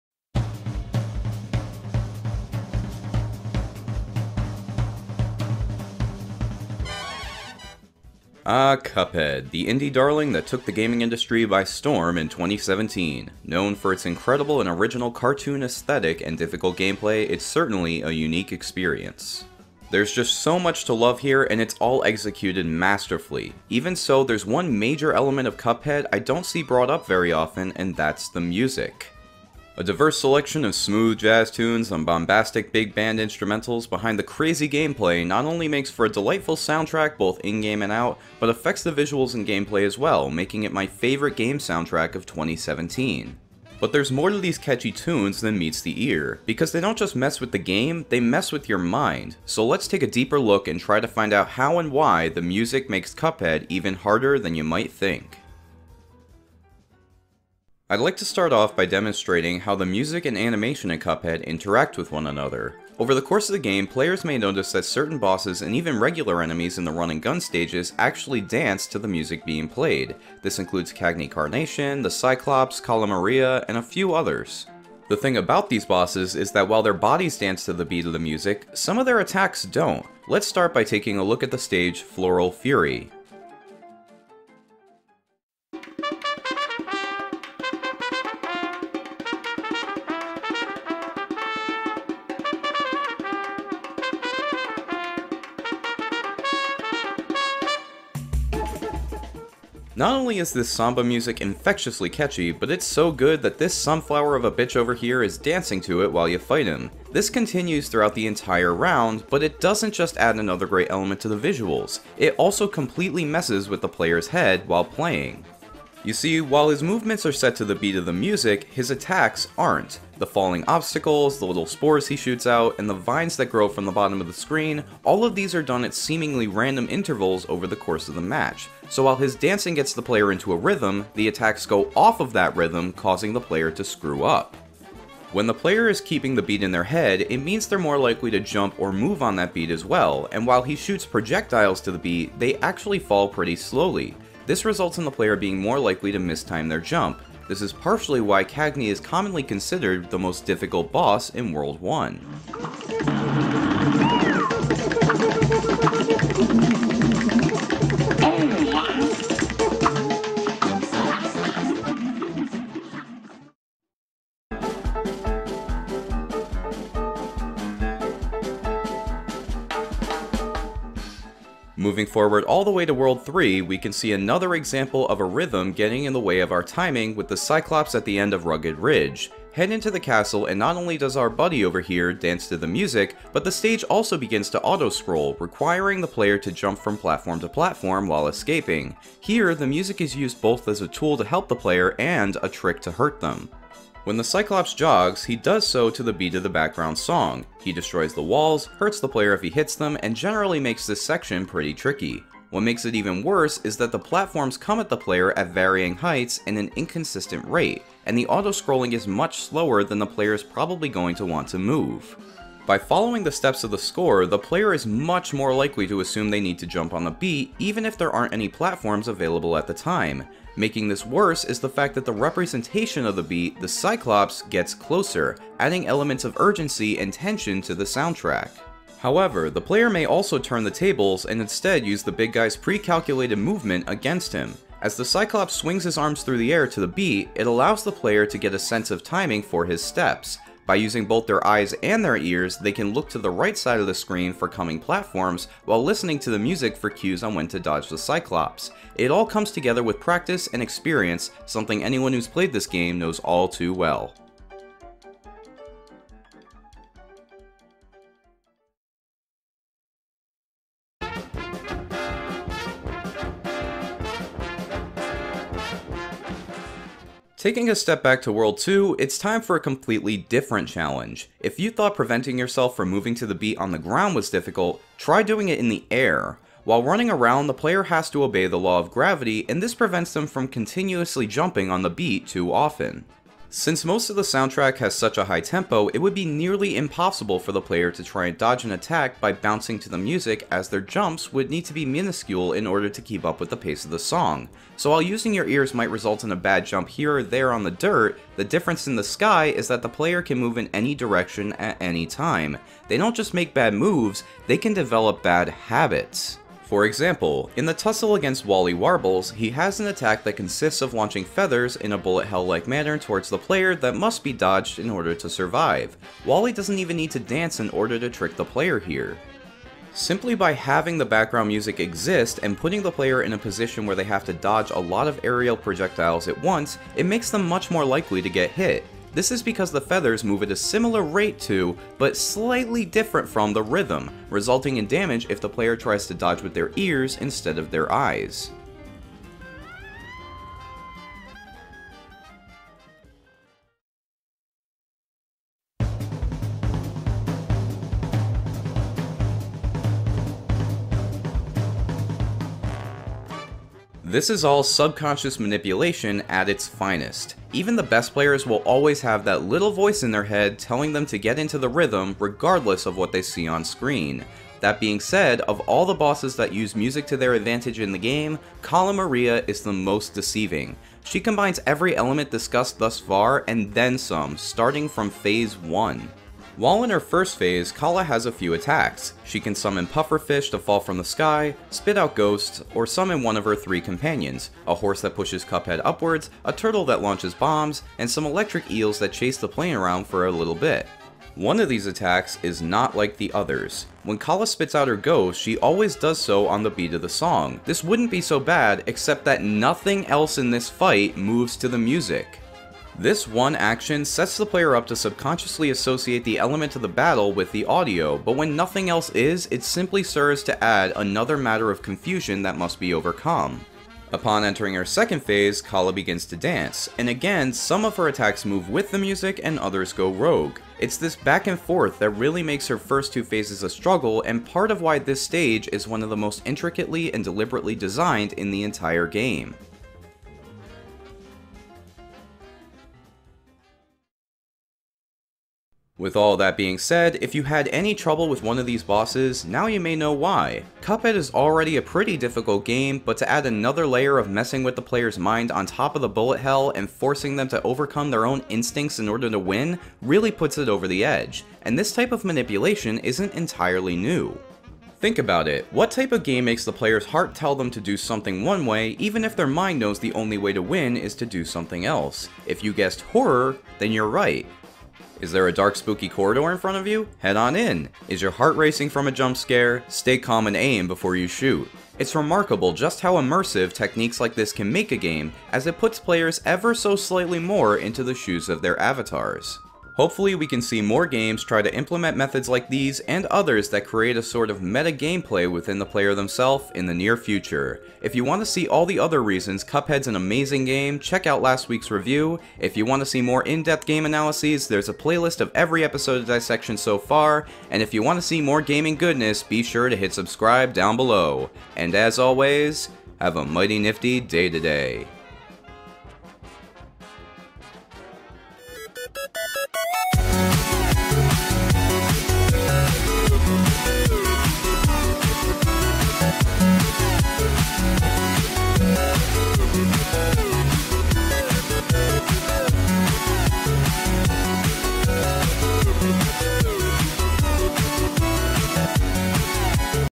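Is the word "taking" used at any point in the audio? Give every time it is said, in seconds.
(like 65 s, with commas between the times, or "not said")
80 s, 267 s.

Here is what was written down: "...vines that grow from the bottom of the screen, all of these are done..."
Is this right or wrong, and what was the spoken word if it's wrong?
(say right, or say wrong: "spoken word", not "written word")
right.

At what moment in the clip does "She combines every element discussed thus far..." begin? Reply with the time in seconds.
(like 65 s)
371 s.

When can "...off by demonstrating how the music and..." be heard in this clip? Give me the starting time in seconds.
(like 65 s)
58 s.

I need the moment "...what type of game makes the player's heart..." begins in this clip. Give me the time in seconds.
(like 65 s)
455 s.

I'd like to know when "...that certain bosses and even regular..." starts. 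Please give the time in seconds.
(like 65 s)
64 s.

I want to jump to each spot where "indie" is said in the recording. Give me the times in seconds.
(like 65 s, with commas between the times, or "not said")
9 s.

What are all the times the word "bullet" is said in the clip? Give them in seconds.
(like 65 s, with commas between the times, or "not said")
311 s, 446 s.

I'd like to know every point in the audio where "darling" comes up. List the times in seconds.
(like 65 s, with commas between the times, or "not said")
9 s.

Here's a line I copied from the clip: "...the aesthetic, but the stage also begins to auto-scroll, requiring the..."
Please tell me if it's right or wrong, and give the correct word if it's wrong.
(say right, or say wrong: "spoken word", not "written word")
wrong: "music", not "aesthetic".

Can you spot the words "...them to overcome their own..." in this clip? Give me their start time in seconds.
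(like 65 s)
447 s.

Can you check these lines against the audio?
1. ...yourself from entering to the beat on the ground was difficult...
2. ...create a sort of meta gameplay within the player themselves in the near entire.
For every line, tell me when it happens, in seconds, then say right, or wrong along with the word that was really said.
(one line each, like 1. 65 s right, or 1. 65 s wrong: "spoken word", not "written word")
1. 272 s wrong: "moving", not "entering"
2. 483 s wrong: "future", not "entire".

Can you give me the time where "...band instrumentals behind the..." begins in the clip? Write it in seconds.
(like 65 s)
32 s.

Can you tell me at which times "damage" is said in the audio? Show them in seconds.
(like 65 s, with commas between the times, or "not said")
334 s.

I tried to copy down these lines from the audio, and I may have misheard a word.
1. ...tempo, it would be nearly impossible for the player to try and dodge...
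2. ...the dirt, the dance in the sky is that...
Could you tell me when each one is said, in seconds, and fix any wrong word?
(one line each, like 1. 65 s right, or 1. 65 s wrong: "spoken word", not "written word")
1. 285 s right
2. 297 s wrong: "difference", not "dance".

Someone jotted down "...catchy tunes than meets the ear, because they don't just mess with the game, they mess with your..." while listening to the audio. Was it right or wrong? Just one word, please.
right.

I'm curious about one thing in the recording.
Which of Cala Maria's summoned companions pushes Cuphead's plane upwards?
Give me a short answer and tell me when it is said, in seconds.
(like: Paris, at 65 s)
A horse, at 384 s.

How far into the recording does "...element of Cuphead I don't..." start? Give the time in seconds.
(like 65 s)
25 s.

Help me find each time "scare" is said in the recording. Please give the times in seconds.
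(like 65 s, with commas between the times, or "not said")
469 s.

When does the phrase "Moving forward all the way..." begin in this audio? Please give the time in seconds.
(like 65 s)
171 s.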